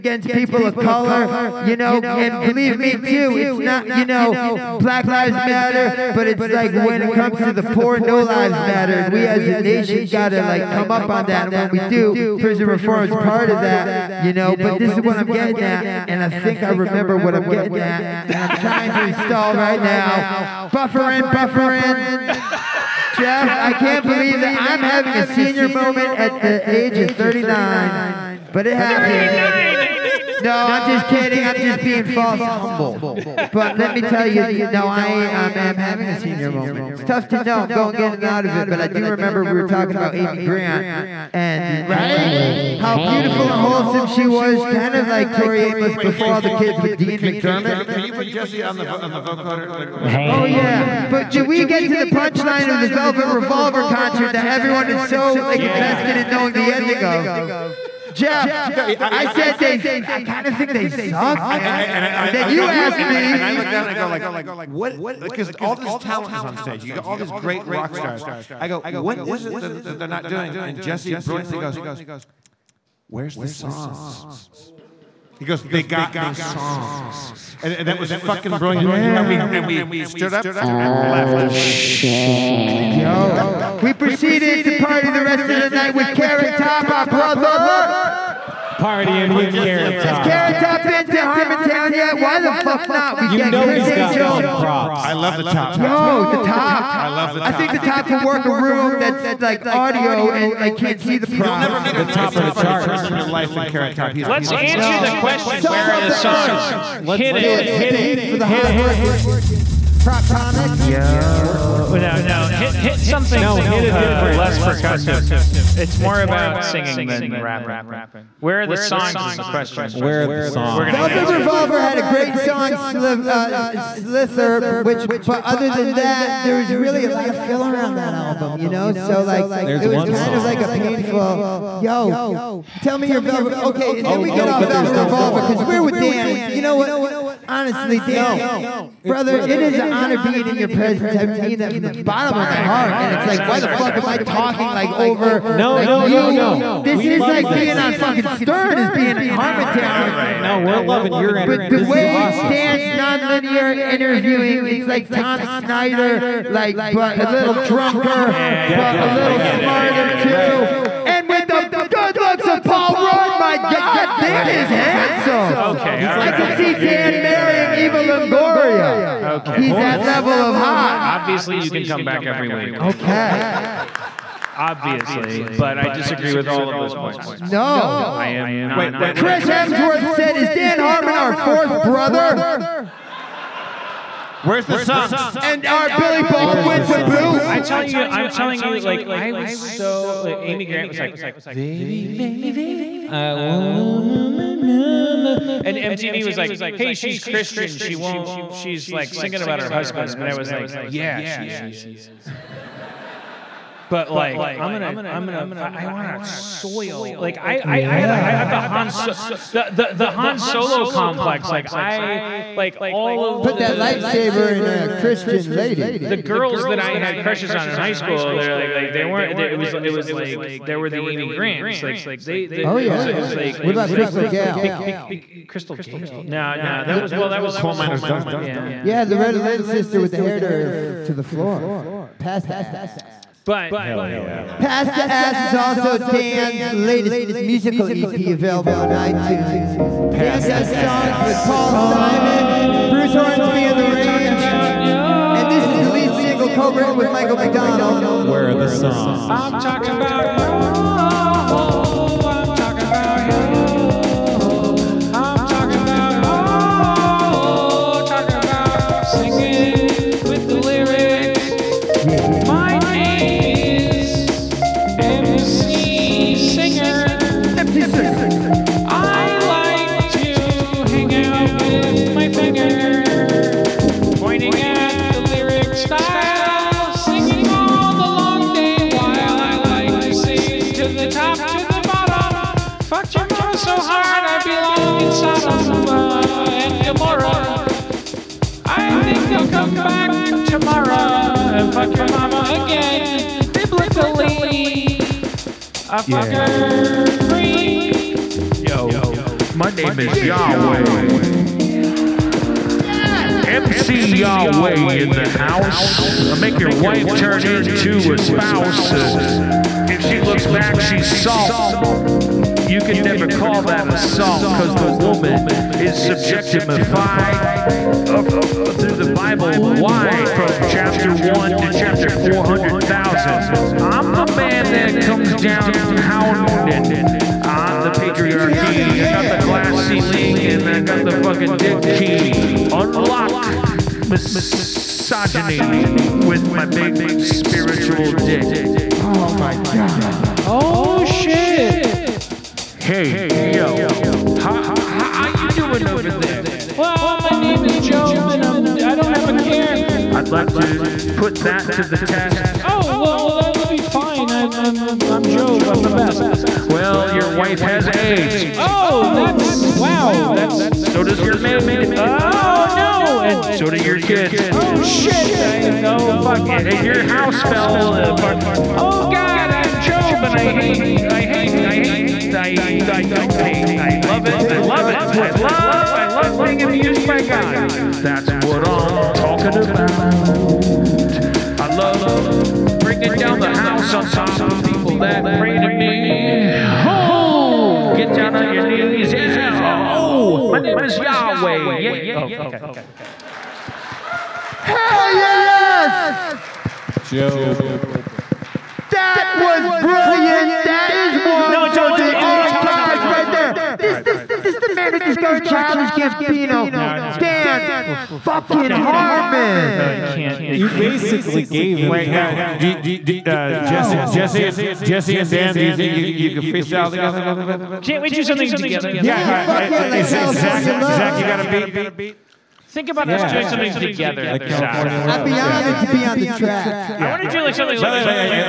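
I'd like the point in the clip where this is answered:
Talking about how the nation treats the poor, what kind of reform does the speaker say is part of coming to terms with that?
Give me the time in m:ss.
0:12.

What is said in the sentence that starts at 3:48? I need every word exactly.
Yeah, yeah, Loretta Lynn's sister with the hair to, to the floor, past the ass.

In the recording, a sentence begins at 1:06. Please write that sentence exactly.
You got all these great rock stars.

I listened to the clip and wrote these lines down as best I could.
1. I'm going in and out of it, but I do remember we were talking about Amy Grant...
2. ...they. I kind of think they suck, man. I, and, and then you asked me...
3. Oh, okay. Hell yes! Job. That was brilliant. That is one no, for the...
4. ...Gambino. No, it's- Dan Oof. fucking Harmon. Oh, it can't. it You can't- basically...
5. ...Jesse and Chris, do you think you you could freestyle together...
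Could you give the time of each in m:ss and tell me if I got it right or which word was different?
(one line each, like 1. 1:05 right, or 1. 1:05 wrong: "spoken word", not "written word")
1. 0:37 right
2. 0:59 right
3. 6:32 right
4. 6:45 right
5. 6:54 wrong: "Dan", not "Chris".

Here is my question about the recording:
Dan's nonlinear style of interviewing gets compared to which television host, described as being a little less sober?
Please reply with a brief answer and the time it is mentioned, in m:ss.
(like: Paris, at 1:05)
Tom Snyder, at 2:35.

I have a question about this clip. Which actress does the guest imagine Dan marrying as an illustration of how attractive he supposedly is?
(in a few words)
Eva Longoria.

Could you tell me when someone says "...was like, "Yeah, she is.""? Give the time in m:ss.
3:20.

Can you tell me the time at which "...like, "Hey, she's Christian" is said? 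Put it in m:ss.
3:16.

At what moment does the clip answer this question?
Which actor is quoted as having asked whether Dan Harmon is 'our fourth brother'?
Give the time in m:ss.
2:59.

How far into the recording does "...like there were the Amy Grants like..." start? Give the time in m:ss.
3:40.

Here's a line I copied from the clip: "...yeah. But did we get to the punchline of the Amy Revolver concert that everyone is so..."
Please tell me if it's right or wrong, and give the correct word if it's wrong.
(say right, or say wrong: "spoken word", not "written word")
wrong: "Velvet", not "Amy".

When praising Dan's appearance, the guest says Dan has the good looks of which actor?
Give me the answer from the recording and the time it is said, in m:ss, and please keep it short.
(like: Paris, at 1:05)
Paul Rudd, at 2:42.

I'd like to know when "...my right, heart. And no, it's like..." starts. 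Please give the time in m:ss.
2:22.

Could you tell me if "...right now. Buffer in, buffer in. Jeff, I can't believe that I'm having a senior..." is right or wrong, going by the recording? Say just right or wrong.
right.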